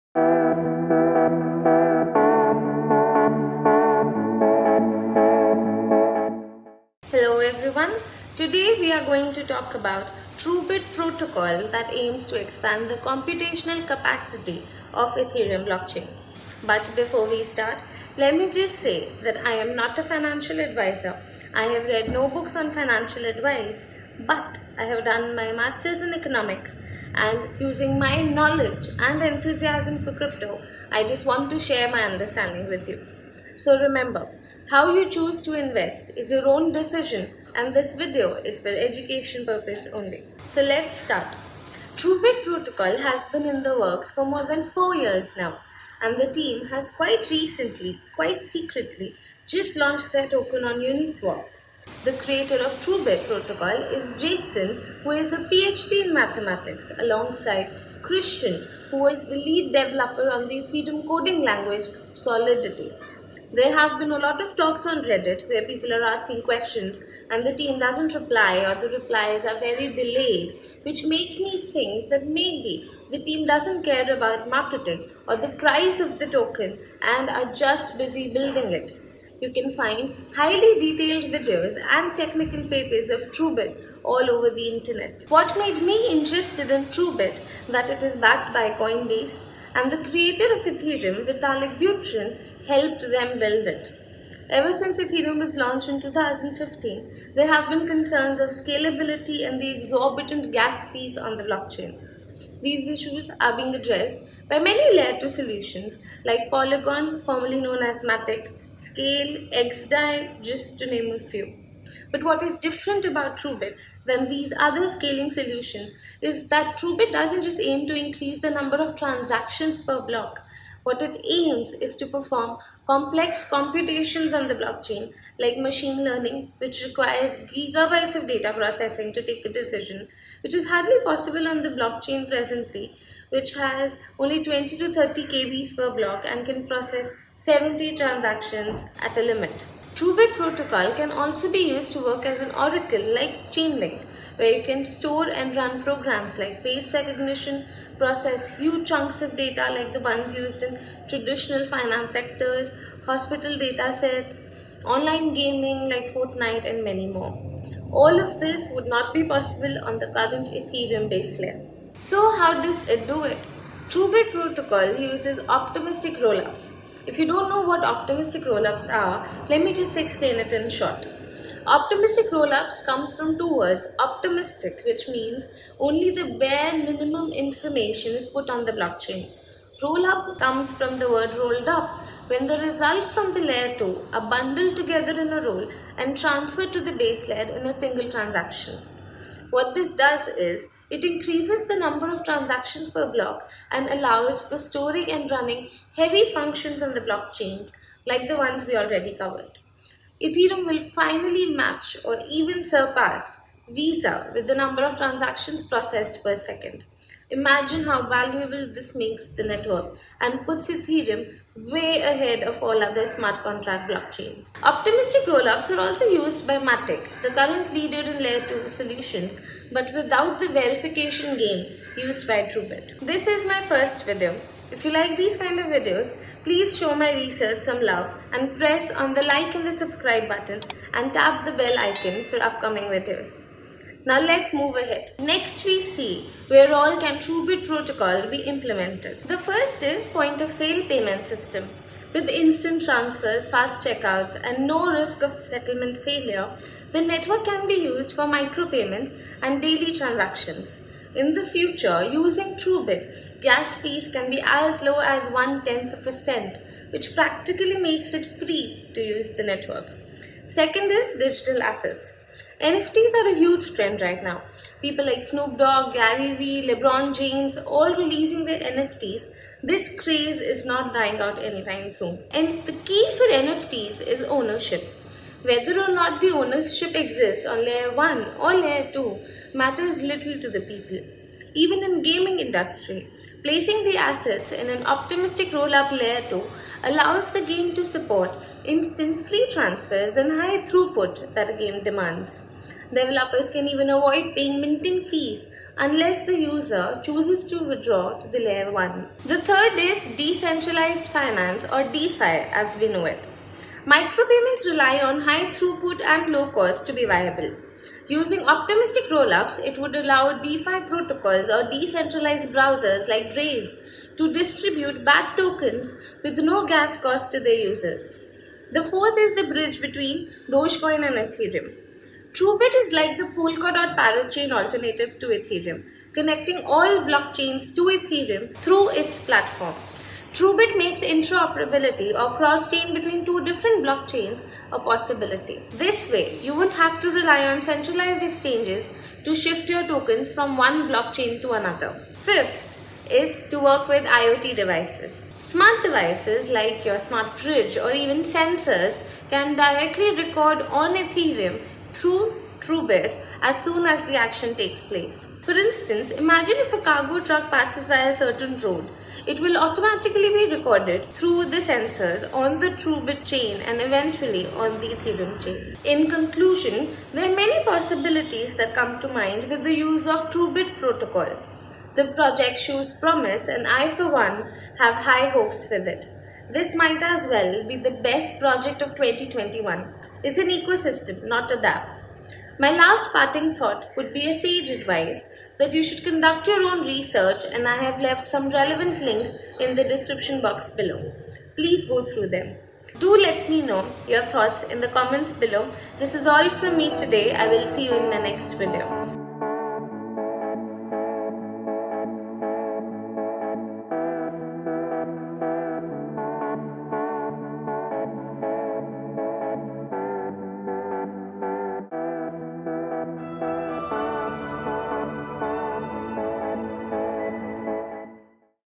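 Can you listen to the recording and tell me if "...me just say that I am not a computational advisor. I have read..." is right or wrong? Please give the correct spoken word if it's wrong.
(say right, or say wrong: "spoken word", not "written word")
wrong: "financial", not "computational".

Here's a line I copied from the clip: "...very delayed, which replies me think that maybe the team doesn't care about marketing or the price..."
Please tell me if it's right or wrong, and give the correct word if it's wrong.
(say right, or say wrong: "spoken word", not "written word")
wrong: "makes", not "replies".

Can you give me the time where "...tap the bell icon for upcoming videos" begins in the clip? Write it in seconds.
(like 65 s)
231 s.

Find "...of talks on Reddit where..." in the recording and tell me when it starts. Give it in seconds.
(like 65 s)
64 s.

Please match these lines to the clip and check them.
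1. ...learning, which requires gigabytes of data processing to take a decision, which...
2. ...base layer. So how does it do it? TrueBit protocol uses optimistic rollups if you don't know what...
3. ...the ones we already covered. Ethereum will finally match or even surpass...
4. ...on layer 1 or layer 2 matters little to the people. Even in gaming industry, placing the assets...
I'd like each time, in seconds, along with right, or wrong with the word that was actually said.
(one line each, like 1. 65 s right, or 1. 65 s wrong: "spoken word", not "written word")
1. 126 s right
2. 161 s right
3. 198 s right
4. 277 s right.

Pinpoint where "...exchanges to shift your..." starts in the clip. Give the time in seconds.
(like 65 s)
338 s.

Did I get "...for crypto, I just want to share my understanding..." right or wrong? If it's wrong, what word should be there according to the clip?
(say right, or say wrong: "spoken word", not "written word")
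right.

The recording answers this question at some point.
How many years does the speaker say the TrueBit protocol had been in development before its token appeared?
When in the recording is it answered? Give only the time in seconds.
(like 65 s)
44 s.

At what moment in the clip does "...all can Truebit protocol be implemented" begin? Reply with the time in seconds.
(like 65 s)
236 s.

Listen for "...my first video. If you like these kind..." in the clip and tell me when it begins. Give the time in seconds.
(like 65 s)
223 s.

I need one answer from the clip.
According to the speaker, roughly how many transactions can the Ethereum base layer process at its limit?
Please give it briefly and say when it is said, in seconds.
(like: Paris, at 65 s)
70, at 137 s.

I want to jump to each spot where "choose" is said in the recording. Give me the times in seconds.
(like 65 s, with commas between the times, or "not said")
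35 s, 297 s.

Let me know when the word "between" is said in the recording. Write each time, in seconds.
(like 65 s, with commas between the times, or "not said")
319 s, 332 s.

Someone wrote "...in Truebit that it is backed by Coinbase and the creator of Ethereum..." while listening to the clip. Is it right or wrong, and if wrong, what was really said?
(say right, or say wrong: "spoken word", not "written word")
right.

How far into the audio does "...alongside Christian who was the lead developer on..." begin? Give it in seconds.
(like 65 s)
56 s.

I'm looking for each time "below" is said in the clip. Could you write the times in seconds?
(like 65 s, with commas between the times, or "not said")
390 s, 395 s.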